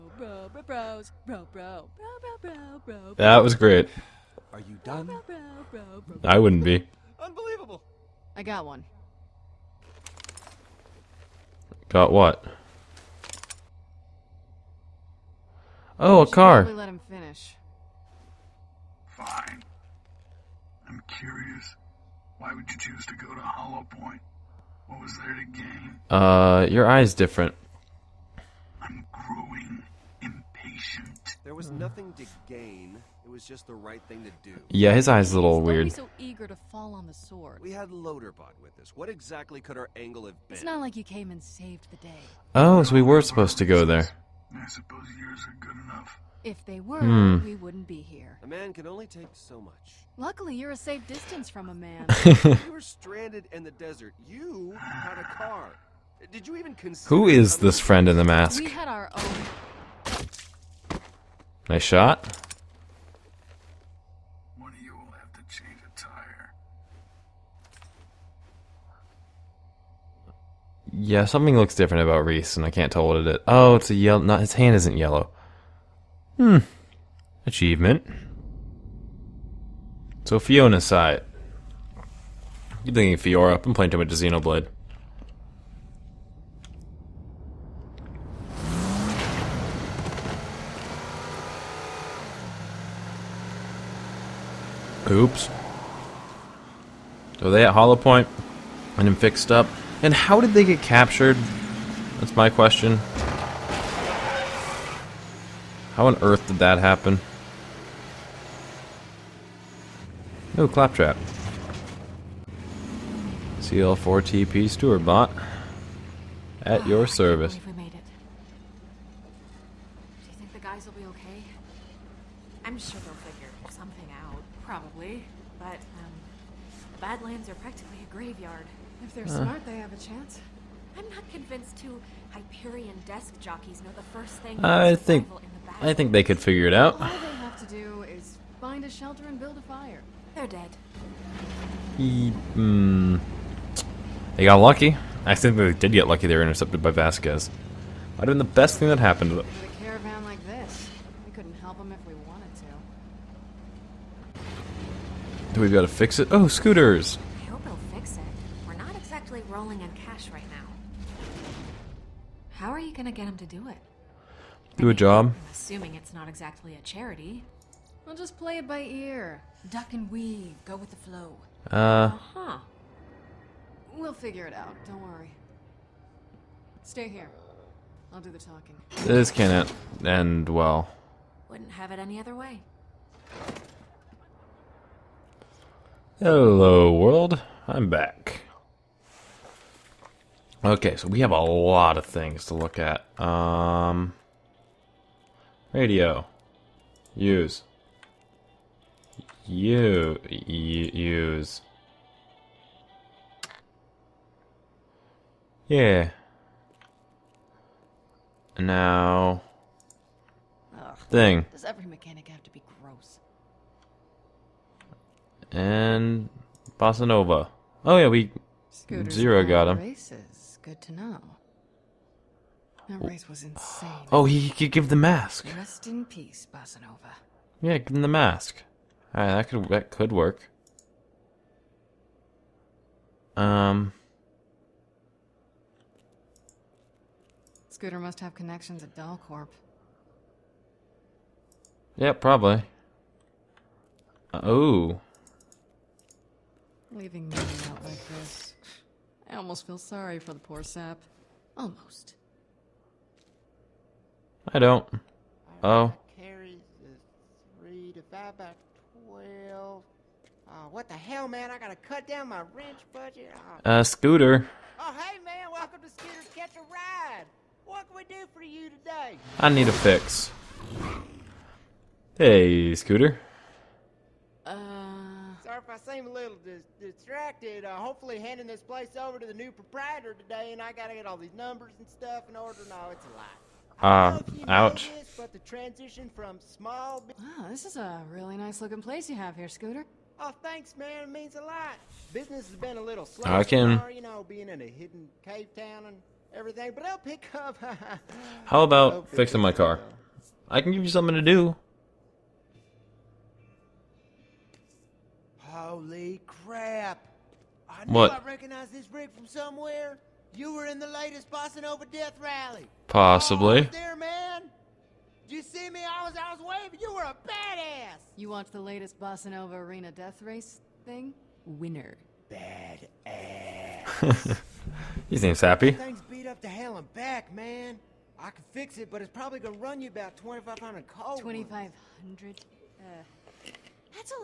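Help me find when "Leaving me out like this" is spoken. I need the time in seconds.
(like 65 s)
246 s.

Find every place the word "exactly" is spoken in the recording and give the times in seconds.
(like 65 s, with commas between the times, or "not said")
39 s, 159 s, 166 s.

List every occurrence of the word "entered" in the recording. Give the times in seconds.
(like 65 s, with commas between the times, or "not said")
not said.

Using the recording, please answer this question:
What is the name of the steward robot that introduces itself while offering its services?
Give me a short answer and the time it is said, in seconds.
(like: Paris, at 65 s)
CL4TP, at 113 s.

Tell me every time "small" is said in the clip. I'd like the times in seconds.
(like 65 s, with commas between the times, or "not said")
286 s.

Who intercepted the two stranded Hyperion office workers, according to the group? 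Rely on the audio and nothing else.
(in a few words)
Vasquez.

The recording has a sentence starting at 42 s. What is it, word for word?
Oh, so we were supposed to go there.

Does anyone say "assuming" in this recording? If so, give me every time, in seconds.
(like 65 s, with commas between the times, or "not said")
165 s.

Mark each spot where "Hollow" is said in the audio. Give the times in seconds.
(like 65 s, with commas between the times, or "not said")
23 s, 97 s.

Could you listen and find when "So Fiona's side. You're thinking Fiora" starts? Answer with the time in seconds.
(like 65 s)
80 s.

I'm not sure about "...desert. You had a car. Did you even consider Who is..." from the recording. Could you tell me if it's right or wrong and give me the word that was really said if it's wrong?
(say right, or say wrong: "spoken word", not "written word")
right.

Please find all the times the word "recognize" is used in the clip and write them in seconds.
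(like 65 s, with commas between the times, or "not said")
308 s.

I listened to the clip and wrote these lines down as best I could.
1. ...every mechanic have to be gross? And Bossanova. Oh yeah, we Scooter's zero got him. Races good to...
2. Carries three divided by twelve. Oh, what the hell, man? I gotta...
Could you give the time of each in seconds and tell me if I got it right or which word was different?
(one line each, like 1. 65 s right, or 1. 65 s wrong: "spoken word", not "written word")
1. 211 s right
2. 256 s right.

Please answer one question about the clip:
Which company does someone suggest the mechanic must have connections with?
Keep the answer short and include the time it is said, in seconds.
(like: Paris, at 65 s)
Dalcorp, at 238 s.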